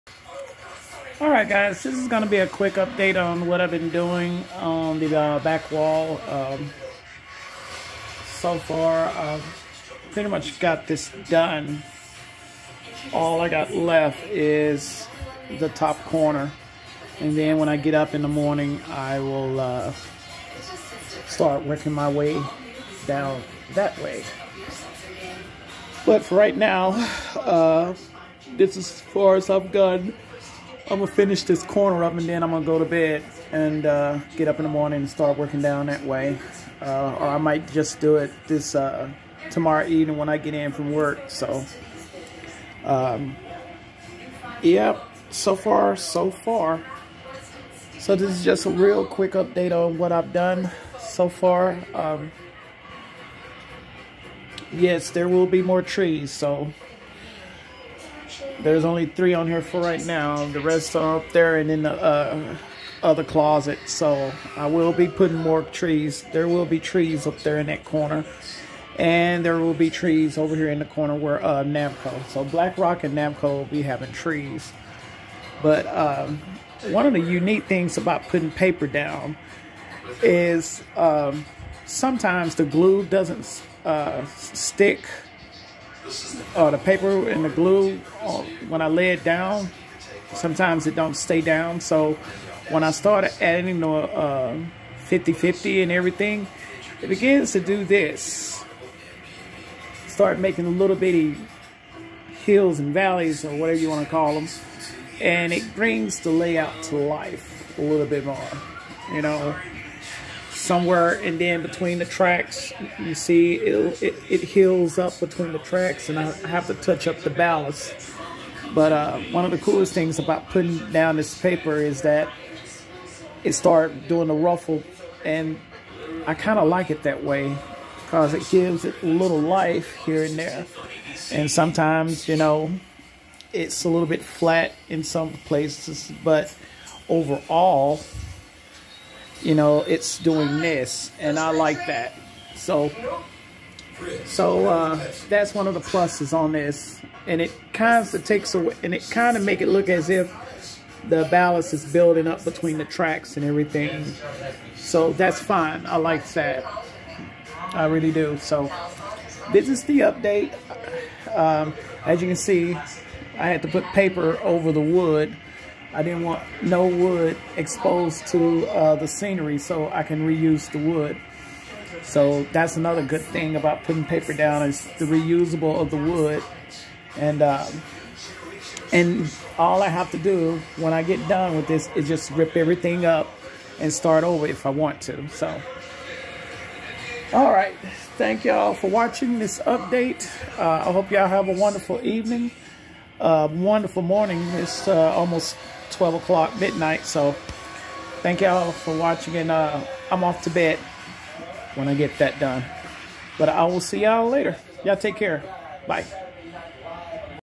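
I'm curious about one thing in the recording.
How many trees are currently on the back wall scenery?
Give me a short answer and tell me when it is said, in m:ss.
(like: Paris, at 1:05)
3, at 0:59.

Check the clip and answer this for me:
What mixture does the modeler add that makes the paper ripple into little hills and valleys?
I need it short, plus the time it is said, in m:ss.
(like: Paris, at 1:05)
50-50, at 1:35.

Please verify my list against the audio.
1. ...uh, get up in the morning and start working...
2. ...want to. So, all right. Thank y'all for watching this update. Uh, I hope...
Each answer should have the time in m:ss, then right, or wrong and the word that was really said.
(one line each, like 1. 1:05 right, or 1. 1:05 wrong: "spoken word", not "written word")
1. 0:33 right
2. 3:04 right.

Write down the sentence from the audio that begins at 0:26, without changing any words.
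But for right now, uh, this is as far as I've gone.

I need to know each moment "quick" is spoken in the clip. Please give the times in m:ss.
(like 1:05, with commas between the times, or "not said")
0:02, 0:49.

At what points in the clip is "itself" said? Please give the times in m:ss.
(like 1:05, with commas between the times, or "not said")
not said.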